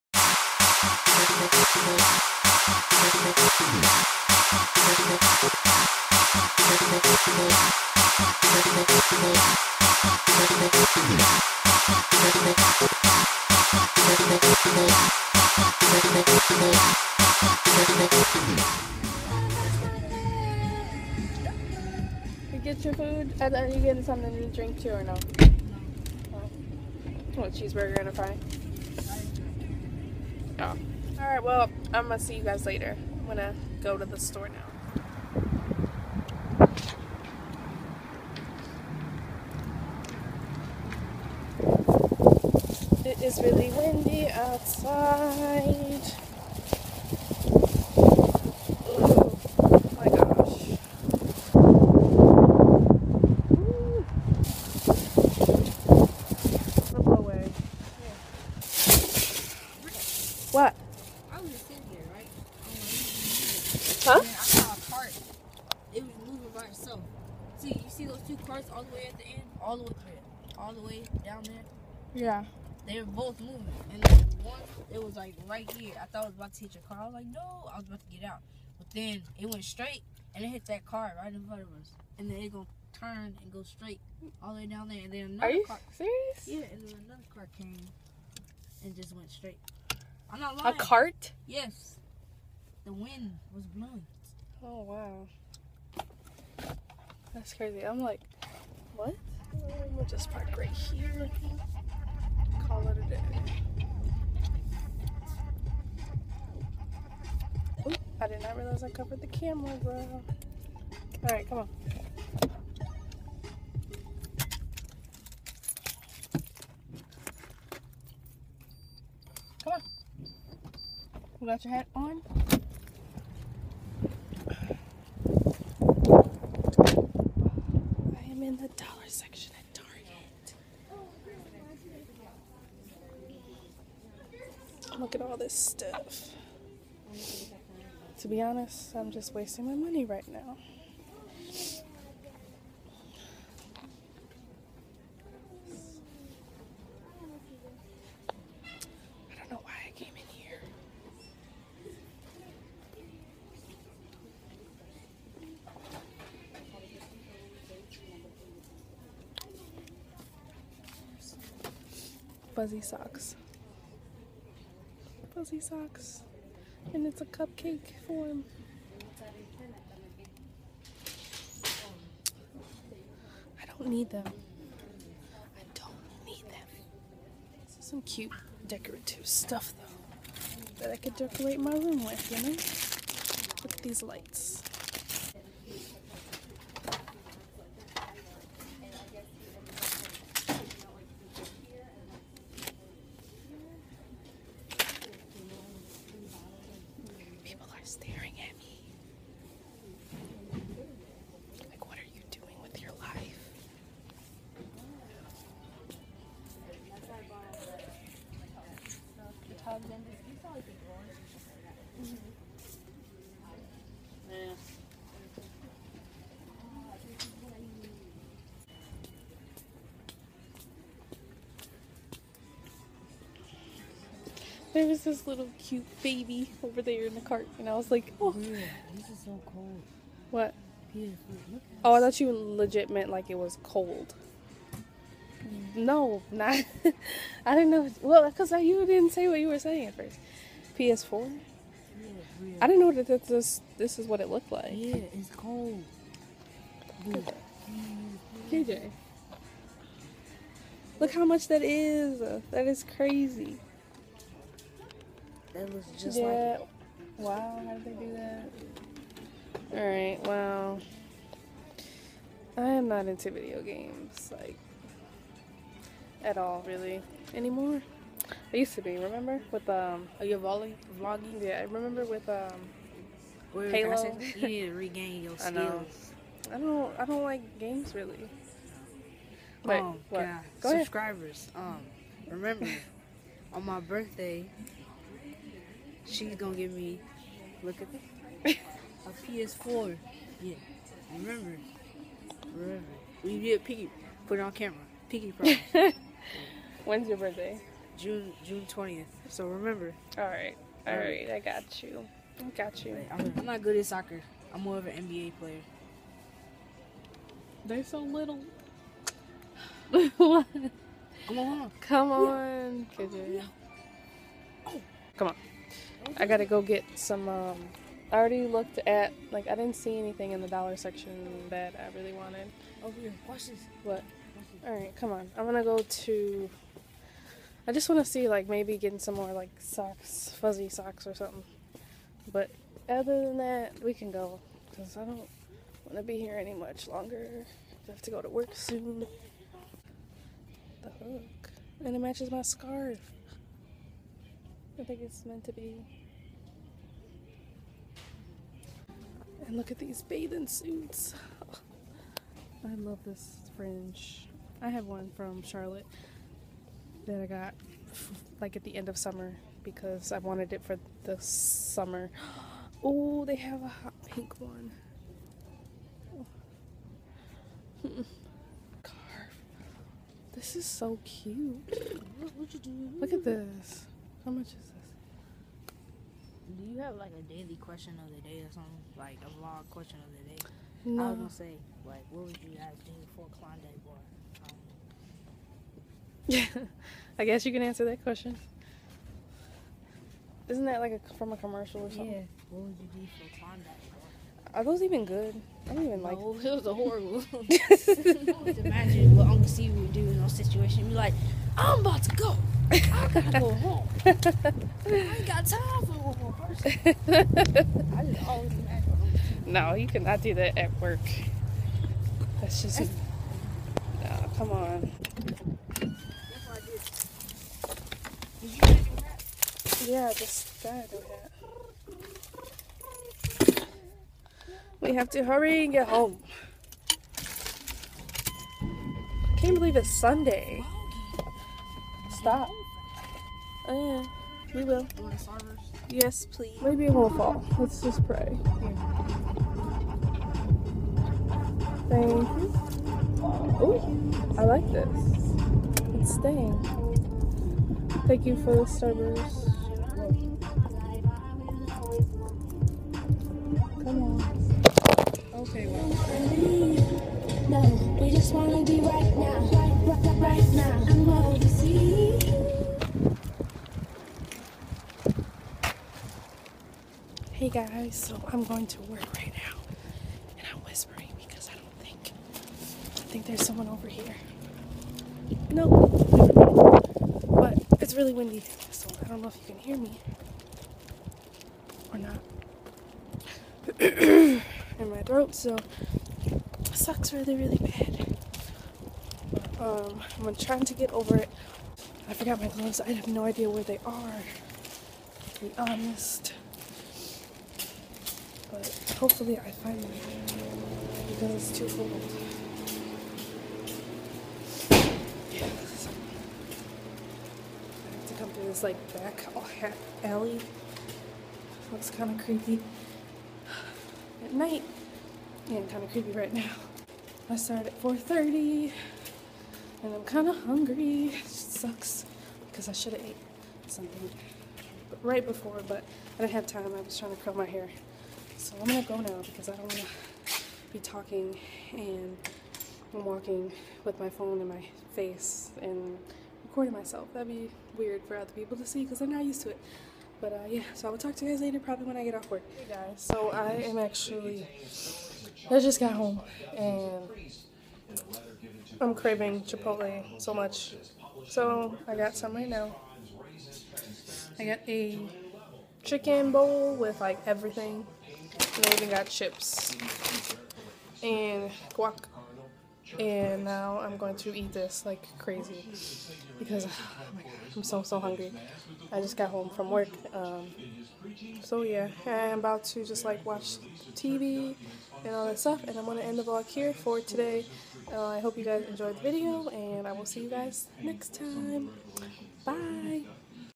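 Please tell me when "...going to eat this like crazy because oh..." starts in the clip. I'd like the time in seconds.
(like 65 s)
563 s.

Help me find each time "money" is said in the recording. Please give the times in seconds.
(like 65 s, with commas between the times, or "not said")
139 s.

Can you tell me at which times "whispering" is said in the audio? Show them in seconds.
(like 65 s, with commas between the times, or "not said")
470 s.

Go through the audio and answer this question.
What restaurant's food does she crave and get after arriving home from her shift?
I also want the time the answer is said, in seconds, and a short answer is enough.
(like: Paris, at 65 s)
Chipotle, at 549 s.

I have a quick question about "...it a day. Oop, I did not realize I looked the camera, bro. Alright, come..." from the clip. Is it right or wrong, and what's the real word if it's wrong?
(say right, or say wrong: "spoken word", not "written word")
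wrong: "covered", not "looked".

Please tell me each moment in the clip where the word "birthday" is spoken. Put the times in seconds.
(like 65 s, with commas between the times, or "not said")
283 s, 297 s.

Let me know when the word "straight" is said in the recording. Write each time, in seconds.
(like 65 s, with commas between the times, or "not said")
79 s, 83 s, 89 s.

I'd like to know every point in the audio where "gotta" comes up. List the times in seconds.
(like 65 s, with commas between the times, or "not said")
316 s, 403 s, 420 s.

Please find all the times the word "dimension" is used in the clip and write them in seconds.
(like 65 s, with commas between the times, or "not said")
not said.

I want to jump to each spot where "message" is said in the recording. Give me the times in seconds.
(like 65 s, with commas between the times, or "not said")
not said.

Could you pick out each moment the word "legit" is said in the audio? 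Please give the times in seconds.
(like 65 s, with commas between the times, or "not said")
232 s.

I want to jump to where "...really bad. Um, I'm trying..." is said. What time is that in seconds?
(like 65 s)
487 s.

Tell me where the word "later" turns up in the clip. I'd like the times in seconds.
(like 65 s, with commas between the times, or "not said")
32 s, 541 s.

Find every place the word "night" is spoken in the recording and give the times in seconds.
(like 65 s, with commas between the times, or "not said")
514 s.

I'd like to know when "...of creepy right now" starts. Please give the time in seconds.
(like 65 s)
515 s.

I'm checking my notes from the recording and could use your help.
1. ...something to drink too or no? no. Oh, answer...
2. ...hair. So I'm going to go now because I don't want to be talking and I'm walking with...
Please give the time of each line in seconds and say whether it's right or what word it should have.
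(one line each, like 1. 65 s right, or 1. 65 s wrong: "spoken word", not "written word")
1. 24 s wrong: "cheeseburger", not "answer"
2. 527 s right.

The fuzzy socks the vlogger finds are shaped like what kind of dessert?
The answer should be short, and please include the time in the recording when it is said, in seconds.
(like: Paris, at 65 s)
cupcake, at 167 s.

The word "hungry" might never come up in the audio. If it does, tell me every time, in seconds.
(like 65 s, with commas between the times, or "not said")
520 s, 568 s.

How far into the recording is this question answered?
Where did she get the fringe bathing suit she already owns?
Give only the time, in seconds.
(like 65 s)
355 s.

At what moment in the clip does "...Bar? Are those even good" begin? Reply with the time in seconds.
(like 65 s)
393 s.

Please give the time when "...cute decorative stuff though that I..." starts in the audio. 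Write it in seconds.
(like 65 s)
178 s.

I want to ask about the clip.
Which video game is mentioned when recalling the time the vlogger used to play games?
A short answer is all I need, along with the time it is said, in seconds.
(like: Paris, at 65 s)
Halo, at 273 s.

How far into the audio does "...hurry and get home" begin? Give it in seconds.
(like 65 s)
425 s.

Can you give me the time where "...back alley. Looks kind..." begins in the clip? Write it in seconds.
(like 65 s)
508 s.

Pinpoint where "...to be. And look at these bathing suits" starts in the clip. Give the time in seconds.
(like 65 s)
345 s.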